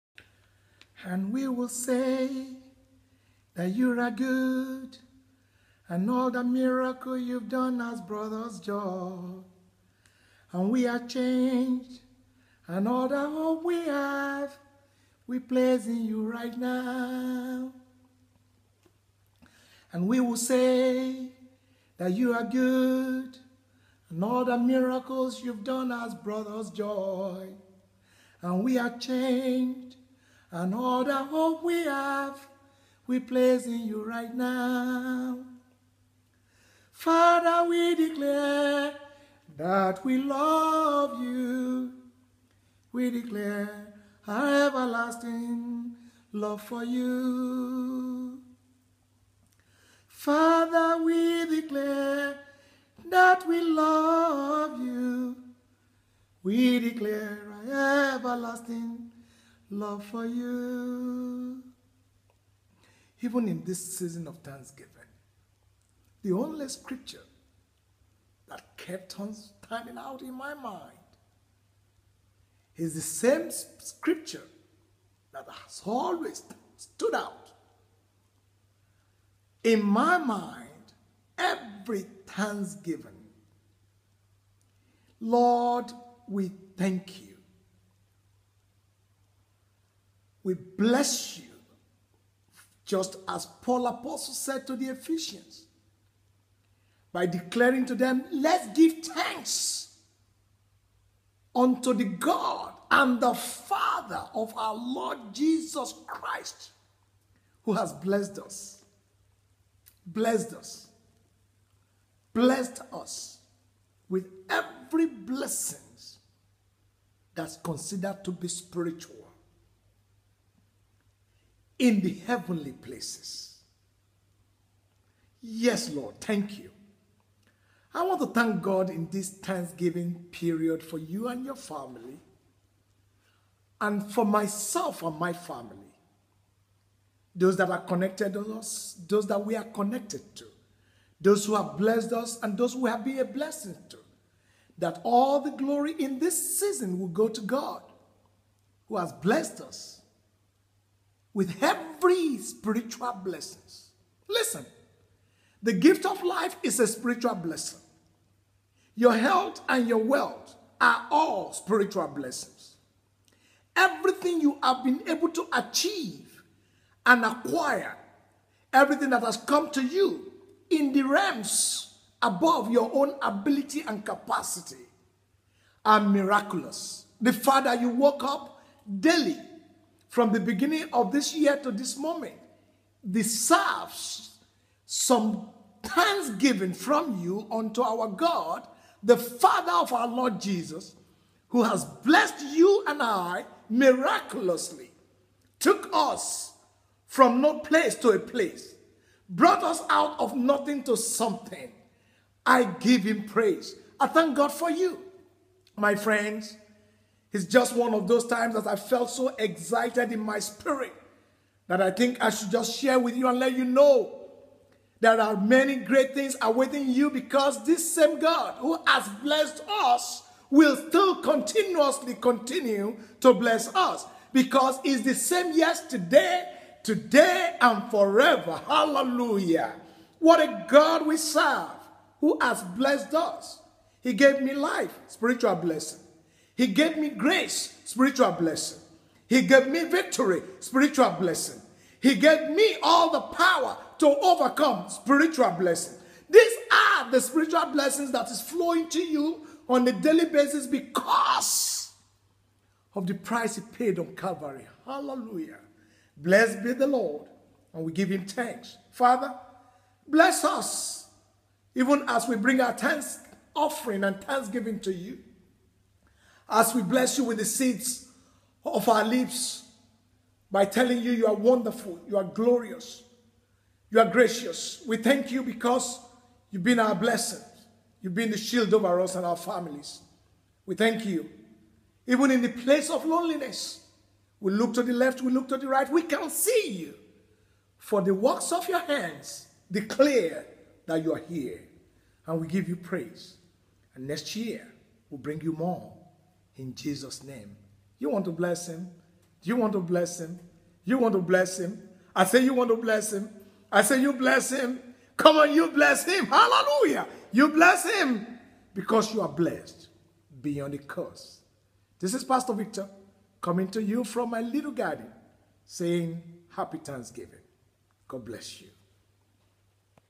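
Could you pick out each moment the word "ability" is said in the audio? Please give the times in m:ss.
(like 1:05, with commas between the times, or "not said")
2:53.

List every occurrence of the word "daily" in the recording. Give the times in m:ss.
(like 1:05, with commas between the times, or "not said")
2:58, 4:09.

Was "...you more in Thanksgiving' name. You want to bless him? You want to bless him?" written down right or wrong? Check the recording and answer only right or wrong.
wrong.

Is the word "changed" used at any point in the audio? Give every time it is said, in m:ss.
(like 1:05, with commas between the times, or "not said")
0:11, 0:28.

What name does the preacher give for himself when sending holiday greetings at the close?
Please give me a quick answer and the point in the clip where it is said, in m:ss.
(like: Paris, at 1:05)
Pastor Victor, at 5:12.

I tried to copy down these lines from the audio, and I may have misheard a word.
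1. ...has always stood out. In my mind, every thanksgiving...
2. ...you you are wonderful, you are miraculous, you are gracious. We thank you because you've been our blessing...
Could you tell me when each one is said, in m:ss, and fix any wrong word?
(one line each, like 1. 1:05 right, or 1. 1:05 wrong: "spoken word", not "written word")
1. 1:15 right
2. 4:31 wrong: "glorious", not "miraculous".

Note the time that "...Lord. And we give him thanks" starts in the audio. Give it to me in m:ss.
4:16.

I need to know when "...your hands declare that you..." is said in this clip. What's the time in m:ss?
4:48.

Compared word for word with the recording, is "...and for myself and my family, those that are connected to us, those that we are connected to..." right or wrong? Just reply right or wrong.
right.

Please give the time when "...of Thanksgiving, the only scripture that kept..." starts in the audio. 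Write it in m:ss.
1:04.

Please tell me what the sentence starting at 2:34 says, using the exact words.
Listen, the gift of life is a spiritual blessing.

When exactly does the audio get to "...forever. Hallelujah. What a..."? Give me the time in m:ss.
3:47.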